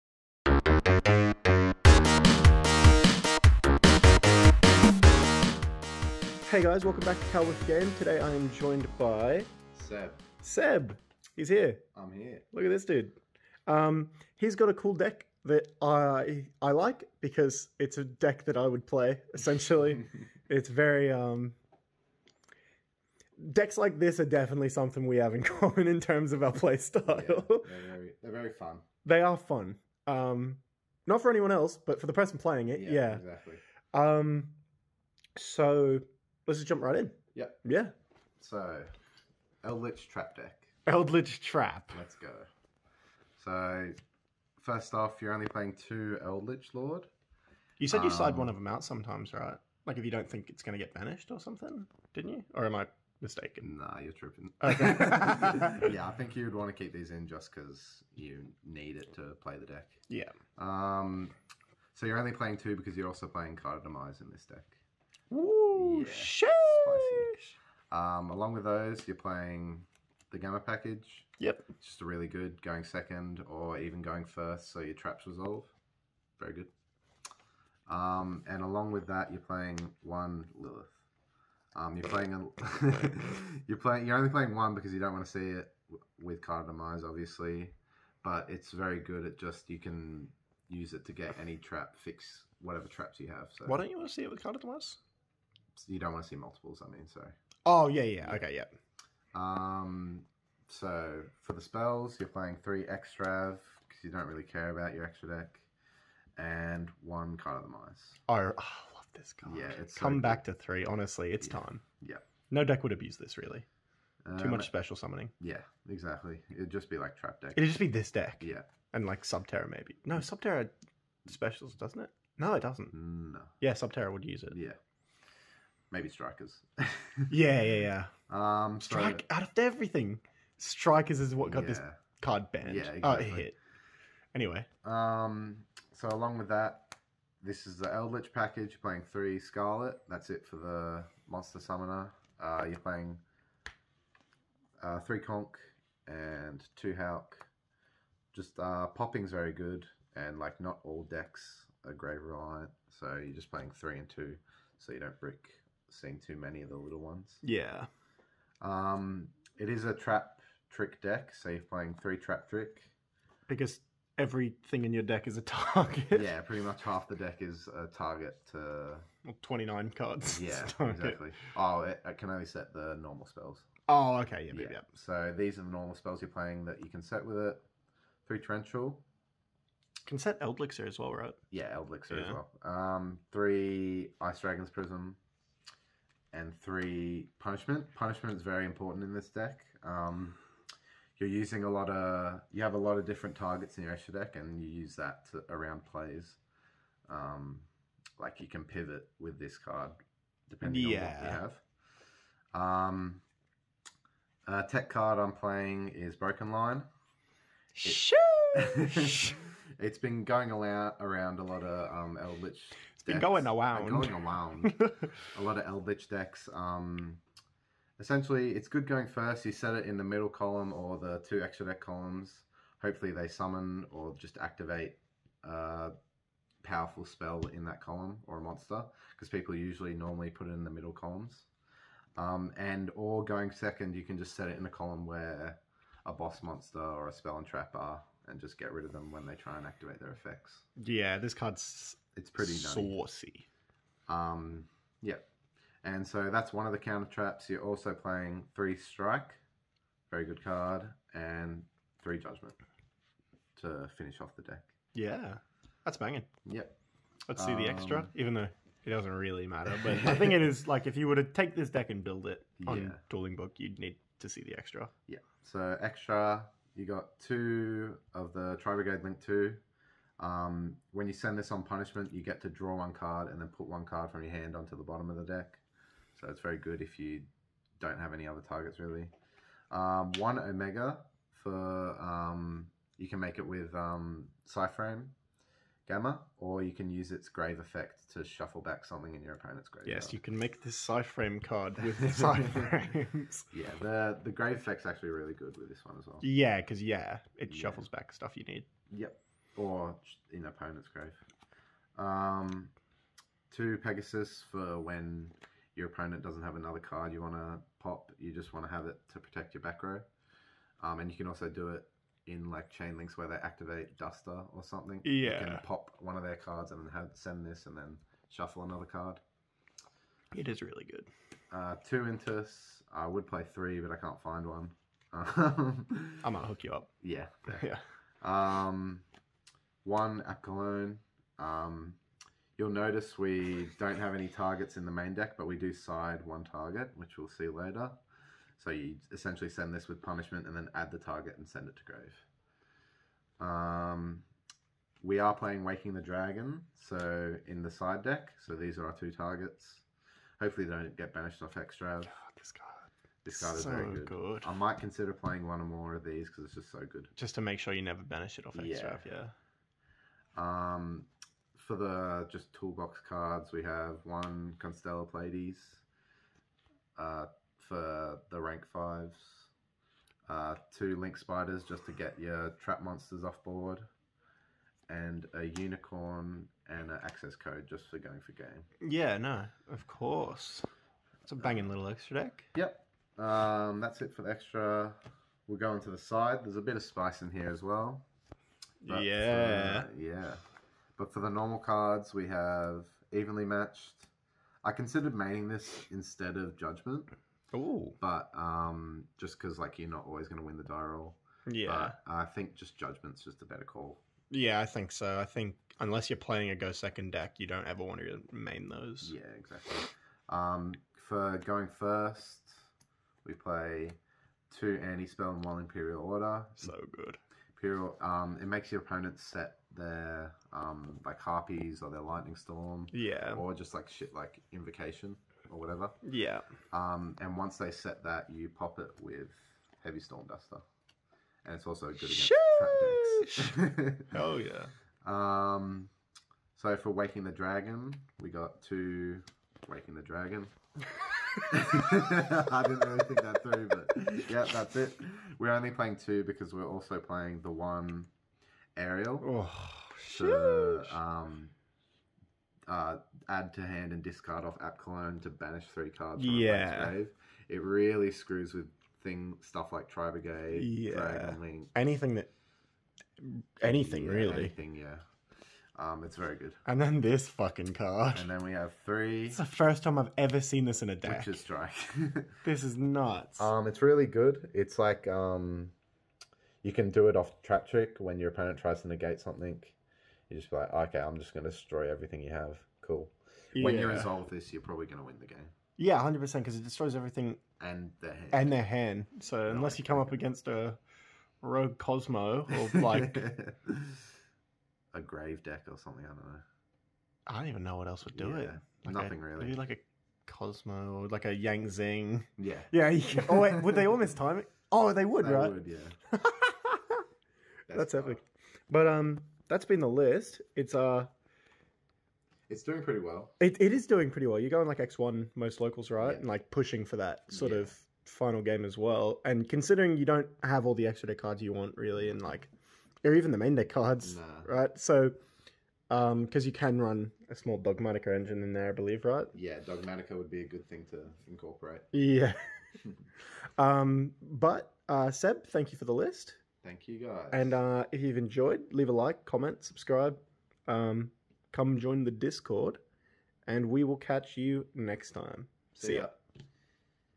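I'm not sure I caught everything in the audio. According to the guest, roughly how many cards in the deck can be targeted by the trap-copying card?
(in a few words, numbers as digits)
29.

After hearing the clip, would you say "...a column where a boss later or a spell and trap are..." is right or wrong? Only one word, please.
wrong.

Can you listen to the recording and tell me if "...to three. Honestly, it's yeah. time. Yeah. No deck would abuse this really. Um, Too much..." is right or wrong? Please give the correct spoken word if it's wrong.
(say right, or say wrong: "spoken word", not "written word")
right.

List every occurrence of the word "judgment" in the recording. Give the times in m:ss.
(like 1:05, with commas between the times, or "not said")
4:12, 6:36, 6:42.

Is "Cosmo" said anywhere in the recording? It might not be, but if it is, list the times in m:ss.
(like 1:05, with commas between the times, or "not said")
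8:11, 8:20.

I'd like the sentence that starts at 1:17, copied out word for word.
Um, and along with that, you're playing one Lilith.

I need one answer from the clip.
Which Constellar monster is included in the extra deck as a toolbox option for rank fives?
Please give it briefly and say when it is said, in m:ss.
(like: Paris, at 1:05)
Constellar Pleiades, at 6:04.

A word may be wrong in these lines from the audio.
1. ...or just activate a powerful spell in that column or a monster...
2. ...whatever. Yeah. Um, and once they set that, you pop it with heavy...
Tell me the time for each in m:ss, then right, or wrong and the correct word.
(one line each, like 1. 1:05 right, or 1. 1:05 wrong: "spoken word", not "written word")
1. 3:43 right
2. 7:05 right.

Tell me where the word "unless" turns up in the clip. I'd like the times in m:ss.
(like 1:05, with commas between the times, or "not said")
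6:45, 8:09.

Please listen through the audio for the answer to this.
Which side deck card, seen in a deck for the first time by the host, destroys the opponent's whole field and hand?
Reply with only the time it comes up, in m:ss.
7:51.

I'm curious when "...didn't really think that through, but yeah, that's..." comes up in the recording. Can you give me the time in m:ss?
7:22.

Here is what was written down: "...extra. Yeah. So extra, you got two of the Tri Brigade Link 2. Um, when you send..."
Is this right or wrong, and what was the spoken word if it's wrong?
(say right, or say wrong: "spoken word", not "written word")
right.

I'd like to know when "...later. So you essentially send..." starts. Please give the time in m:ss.
5:37.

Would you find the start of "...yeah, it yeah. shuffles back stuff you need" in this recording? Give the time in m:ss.
4:56.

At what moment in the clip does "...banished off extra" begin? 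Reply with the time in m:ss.
5:51.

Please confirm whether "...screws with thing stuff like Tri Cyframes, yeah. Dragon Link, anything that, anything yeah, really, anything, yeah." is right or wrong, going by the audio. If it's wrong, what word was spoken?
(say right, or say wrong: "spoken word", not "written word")
wrong: "Brigade", not "Cyframes".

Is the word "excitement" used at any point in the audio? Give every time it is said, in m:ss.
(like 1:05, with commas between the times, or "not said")
not said.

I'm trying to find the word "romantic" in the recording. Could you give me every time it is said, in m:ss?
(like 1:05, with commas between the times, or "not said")
not said.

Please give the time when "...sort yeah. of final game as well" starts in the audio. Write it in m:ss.
8:37.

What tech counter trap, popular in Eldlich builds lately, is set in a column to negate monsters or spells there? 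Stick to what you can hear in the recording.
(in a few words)
Broken Line.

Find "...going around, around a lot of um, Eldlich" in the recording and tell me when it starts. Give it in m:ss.
3:30.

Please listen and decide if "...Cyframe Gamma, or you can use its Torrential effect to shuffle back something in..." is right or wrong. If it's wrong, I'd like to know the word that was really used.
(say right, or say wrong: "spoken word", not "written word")
wrong: "Grave", not "Torrential".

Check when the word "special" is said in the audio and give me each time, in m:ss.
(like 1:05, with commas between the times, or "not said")
1:54, 2:01.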